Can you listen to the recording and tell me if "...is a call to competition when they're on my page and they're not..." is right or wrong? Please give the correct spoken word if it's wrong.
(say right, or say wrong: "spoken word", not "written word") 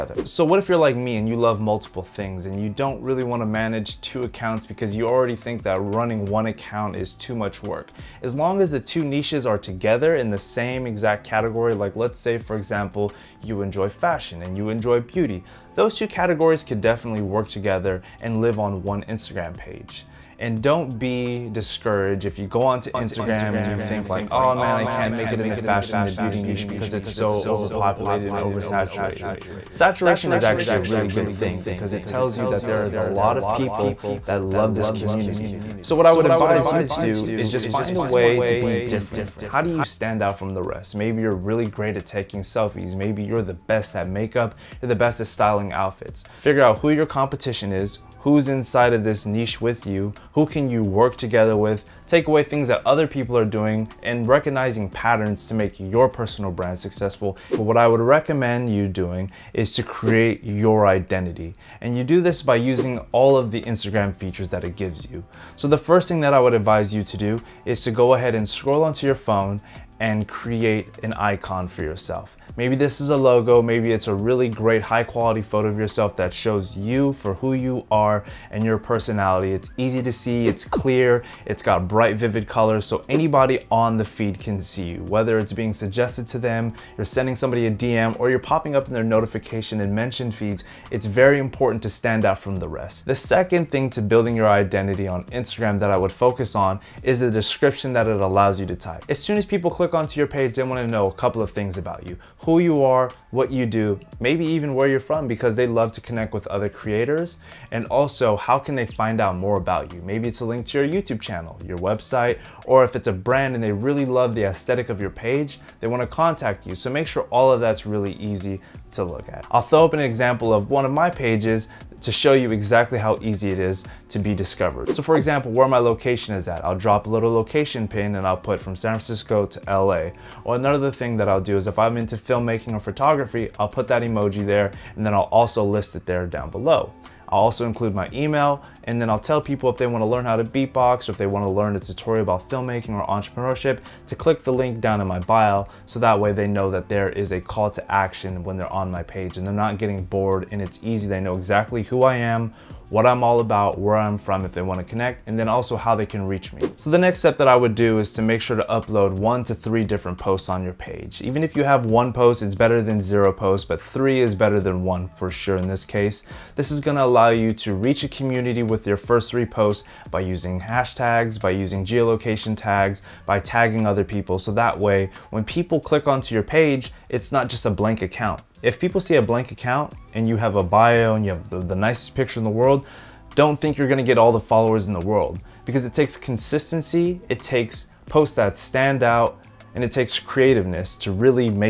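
wrong: "action", not "competition".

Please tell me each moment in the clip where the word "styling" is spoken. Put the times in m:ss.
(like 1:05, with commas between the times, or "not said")
0:45.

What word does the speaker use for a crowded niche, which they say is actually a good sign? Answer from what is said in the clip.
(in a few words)
Saturation.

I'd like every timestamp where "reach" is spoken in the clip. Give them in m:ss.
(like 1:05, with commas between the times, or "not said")
2:36, 2:47.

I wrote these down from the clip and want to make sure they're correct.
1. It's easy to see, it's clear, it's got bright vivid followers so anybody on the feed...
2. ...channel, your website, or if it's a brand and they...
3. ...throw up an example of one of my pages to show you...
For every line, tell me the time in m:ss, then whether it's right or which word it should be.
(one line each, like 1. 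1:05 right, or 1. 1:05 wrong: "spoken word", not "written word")
1. 1:19 wrong: "colors", not "followers"
2. 1:51 right
3. 1:59 right.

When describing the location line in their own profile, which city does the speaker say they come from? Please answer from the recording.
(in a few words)
San Francisco.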